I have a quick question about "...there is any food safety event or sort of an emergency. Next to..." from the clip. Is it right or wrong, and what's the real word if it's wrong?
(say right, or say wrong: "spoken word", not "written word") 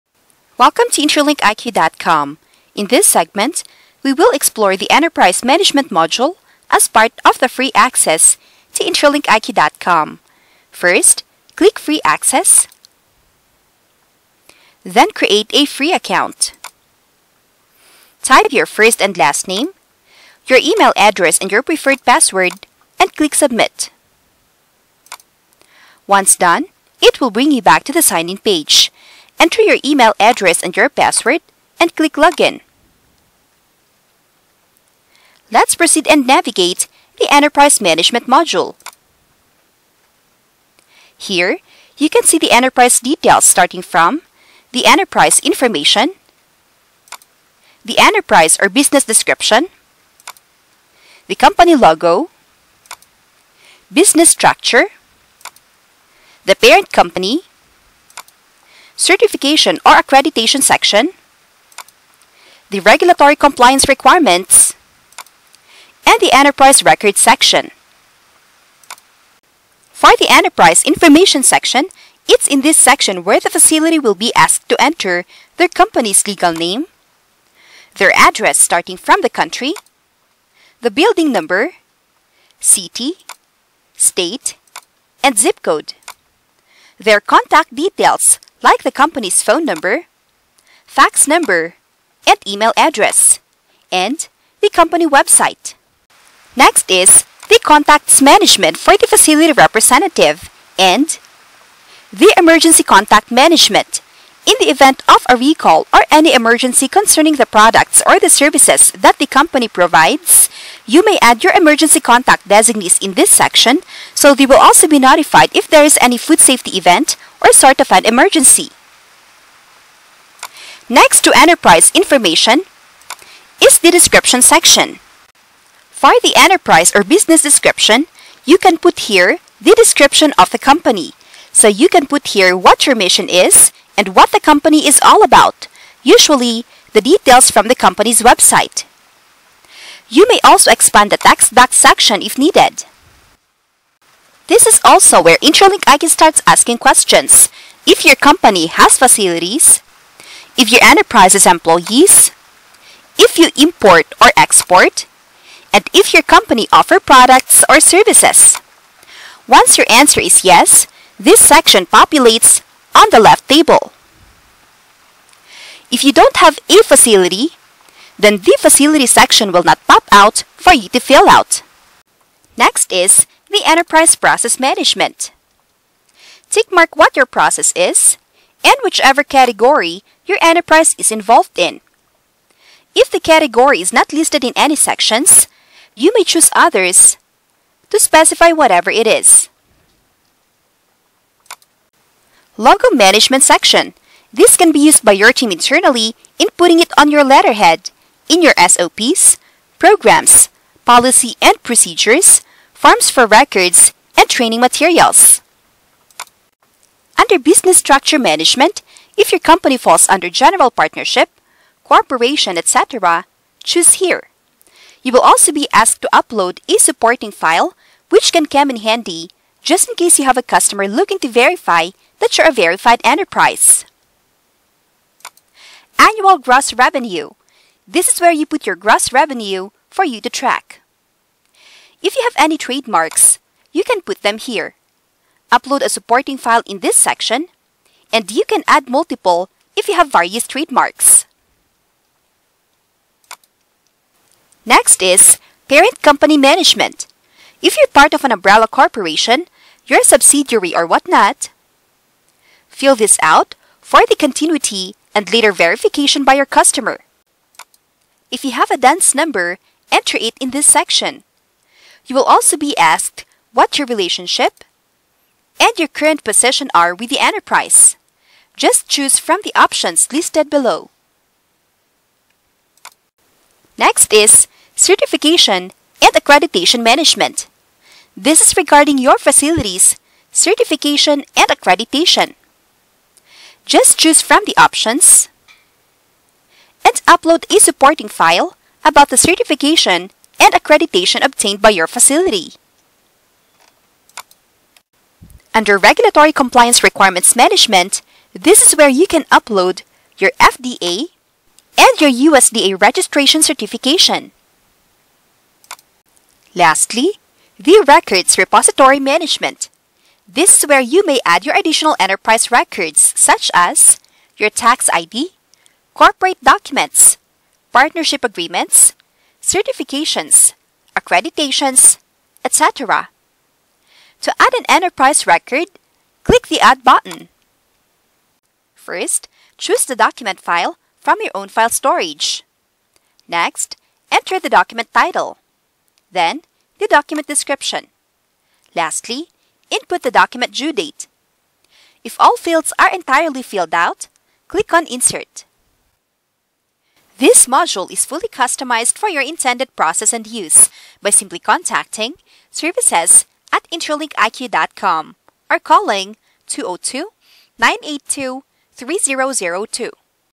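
right.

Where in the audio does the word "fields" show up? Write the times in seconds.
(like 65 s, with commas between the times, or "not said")
342 s.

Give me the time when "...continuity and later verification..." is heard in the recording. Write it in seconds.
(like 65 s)
254 s.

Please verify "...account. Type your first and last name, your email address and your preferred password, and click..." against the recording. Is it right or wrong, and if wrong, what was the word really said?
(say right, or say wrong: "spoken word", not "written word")
right.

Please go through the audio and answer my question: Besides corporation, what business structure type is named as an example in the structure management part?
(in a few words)
General Partnership.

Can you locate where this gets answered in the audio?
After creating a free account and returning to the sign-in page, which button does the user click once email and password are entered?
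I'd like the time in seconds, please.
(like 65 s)
32 s.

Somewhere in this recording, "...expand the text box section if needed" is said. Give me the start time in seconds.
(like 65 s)
140 s.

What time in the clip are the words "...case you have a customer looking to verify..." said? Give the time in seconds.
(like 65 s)
219 s.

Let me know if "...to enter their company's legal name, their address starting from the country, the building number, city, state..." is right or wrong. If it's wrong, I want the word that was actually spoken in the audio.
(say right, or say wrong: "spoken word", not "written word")
right.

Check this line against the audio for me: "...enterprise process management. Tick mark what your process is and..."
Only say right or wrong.
right.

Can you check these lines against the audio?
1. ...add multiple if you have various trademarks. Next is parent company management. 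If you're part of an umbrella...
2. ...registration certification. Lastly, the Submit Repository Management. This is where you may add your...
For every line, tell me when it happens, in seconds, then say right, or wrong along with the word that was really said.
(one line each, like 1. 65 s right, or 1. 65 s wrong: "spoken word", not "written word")
1. 238 s right
2. 302 s wrong: "Records", not "Submit".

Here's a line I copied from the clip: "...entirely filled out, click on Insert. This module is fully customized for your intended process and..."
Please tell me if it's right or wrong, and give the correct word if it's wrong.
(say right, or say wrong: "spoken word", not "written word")
right.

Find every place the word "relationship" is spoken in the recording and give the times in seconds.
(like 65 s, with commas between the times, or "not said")
263 s.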